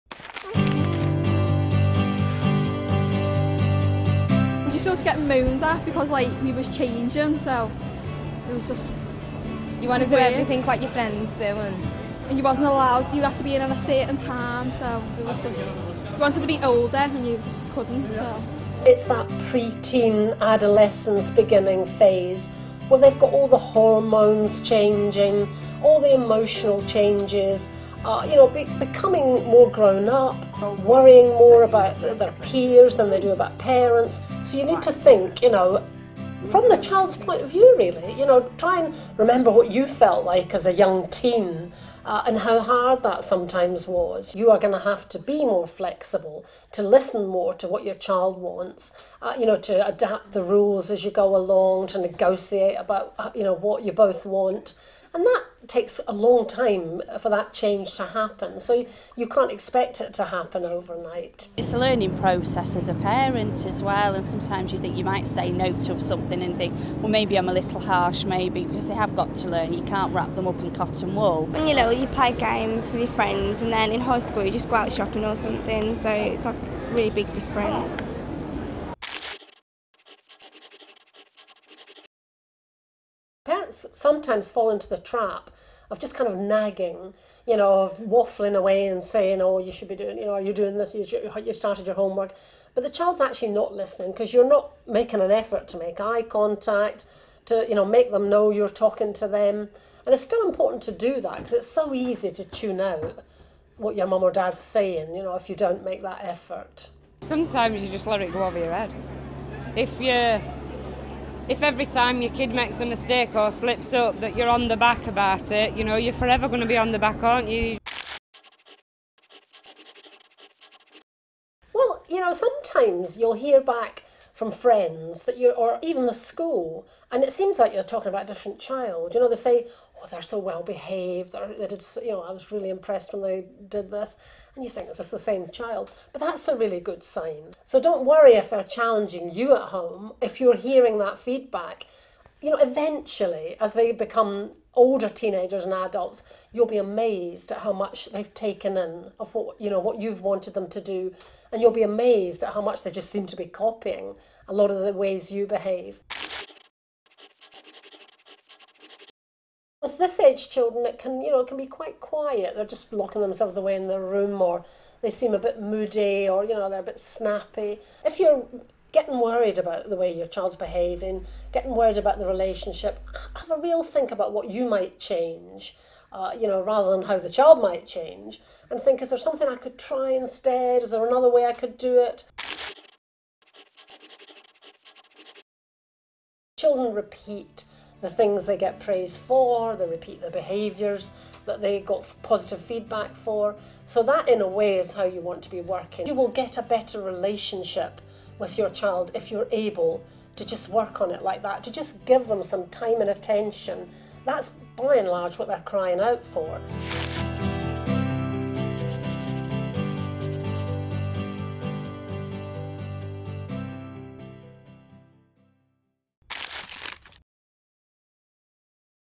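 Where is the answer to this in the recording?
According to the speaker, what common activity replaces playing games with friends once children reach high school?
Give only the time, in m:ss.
1:14.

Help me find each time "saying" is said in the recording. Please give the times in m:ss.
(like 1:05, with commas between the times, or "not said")
1:29, 1:44.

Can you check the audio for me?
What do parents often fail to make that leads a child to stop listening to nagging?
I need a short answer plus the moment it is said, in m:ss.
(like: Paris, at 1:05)
Eye contact, at 1:35.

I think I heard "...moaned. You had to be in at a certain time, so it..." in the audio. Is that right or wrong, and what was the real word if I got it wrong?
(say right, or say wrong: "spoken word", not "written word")
wrong: "allowed", not "moaned".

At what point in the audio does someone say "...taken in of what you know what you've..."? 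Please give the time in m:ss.
2:28.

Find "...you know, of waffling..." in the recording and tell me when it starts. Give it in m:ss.
1:27.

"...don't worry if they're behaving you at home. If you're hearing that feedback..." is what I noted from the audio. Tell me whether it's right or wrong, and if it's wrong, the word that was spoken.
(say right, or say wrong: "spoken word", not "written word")
wrong: "challenging", not "behaving".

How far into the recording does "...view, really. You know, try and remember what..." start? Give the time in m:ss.
0:37.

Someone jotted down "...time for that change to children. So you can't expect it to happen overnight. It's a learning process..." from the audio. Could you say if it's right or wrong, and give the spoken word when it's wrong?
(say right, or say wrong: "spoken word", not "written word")
wrong: "happen", not "children".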